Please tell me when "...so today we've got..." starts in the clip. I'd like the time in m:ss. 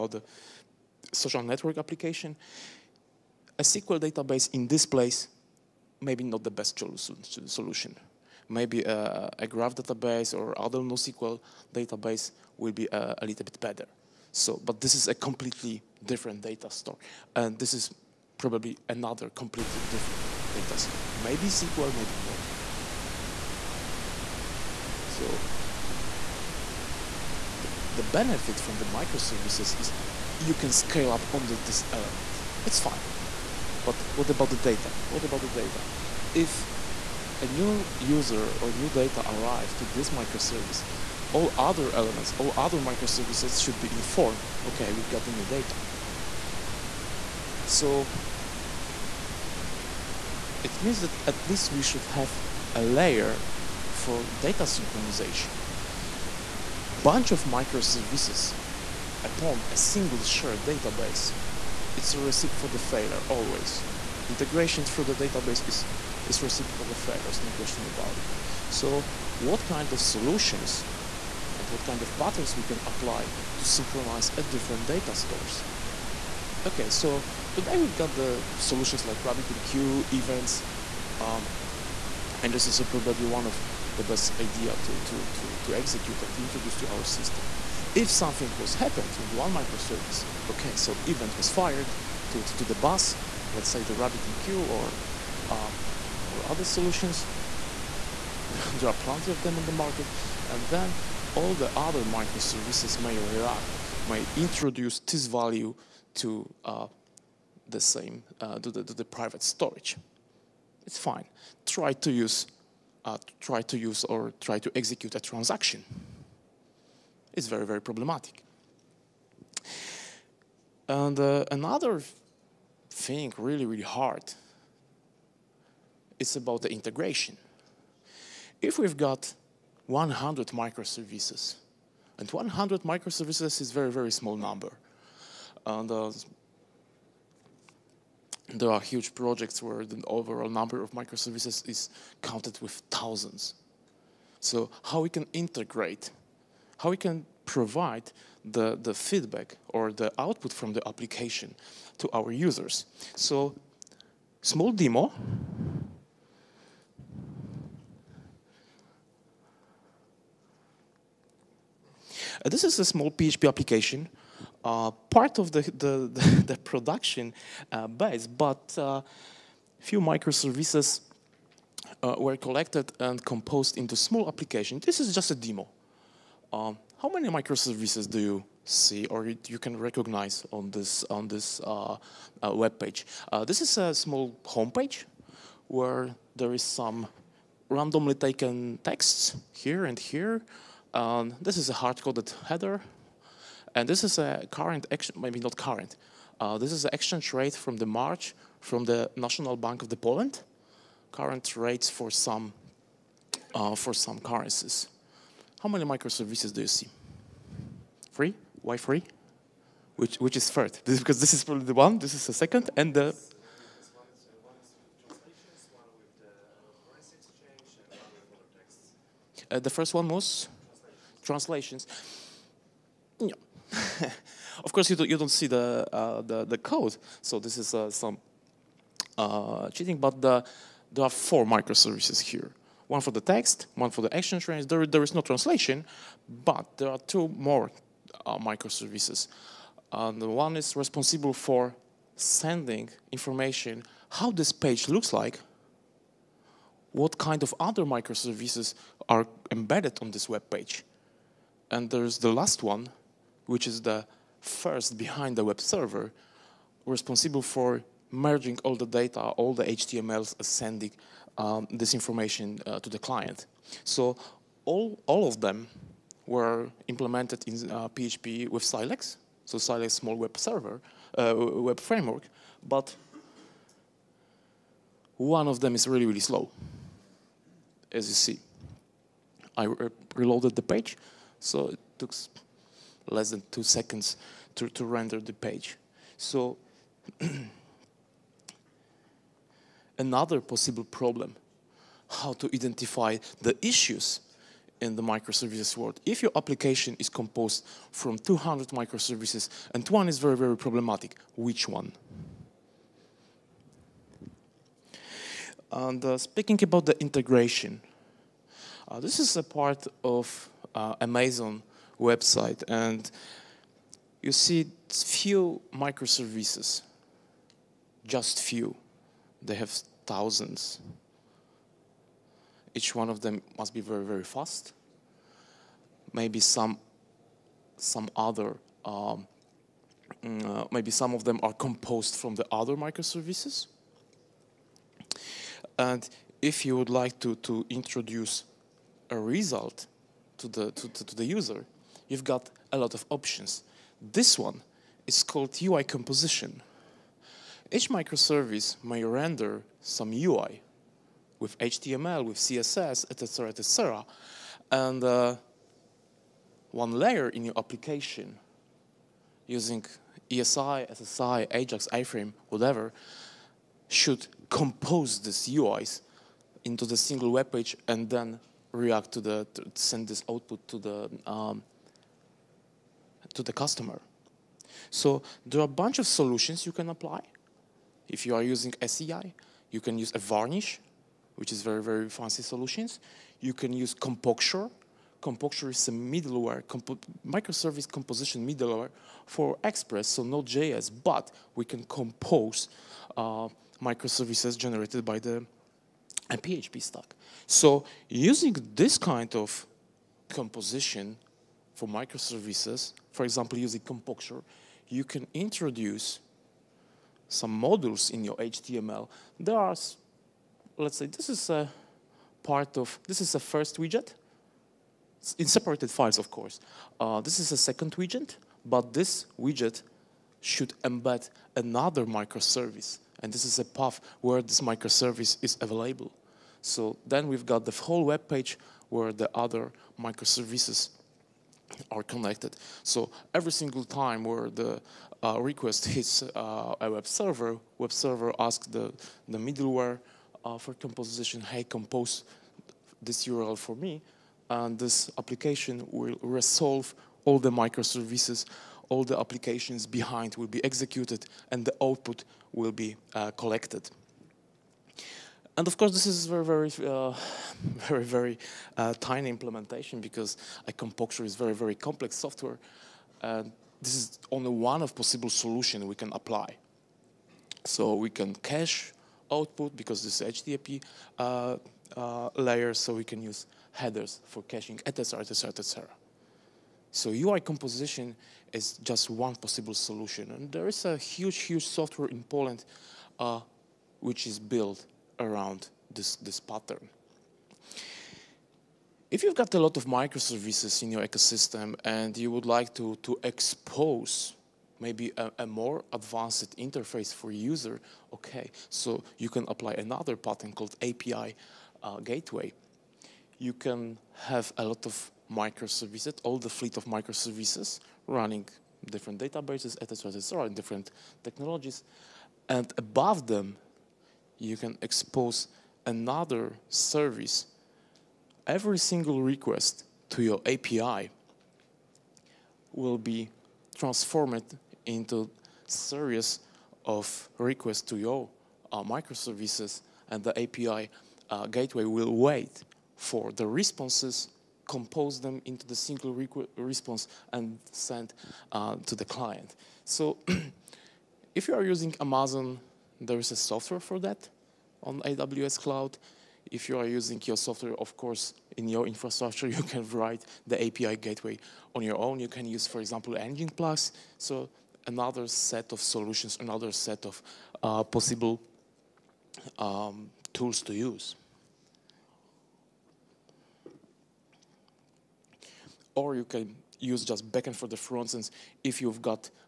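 1:16.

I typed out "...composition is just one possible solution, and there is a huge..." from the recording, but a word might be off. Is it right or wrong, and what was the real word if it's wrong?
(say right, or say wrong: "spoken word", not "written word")
right.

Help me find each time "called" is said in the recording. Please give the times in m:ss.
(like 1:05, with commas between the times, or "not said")
5:45, 8:20.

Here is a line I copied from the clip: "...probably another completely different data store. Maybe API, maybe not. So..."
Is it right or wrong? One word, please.
wrong.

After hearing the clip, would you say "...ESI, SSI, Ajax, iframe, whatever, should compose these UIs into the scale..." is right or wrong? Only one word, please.
wrong.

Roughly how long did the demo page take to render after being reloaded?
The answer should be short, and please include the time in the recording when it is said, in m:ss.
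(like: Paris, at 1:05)
less than 2 seconds, at 4:43.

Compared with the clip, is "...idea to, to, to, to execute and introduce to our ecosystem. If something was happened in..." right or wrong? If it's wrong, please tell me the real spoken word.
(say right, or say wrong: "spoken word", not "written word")
wrong: "system", not "ecosystem".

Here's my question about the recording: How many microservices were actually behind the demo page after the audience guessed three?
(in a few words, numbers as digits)
4.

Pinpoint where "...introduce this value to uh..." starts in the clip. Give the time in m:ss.
1:44.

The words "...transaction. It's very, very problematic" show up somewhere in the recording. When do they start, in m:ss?
1:55.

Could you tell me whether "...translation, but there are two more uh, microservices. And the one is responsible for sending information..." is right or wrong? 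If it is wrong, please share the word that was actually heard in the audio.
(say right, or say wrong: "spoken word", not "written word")
right.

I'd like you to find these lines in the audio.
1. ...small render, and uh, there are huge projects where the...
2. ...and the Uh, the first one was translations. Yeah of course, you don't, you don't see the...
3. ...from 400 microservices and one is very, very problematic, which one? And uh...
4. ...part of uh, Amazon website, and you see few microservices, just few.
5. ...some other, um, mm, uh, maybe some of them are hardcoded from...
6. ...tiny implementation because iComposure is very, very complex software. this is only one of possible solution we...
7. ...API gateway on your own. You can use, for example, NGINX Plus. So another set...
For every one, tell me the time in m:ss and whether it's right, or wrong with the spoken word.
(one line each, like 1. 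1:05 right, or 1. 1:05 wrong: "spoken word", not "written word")
1. 2:14 wrong: "number", not "render"
2. 3:32 right
3. 4:57 wrong: "200", not "400"
4. 5:09 right
5. 5:27 wrong: "composed", not "hardcoded"
6. 7:38 right
7. 9:10 right.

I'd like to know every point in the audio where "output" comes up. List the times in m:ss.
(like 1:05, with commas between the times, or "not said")
2:30, 6:10, 7:31, 7:49.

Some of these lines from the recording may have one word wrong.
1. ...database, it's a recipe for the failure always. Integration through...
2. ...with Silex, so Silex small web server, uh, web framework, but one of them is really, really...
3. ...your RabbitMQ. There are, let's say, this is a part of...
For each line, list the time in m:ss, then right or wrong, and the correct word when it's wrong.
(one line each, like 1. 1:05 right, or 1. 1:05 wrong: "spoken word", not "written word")
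1. 1:00 right
2. 4:28 right
3. 6:48 wrong: "HTML", not "RabbitMQ".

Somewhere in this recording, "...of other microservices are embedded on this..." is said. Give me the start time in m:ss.
4:07.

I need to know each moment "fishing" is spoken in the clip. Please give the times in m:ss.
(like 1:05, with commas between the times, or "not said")
not said.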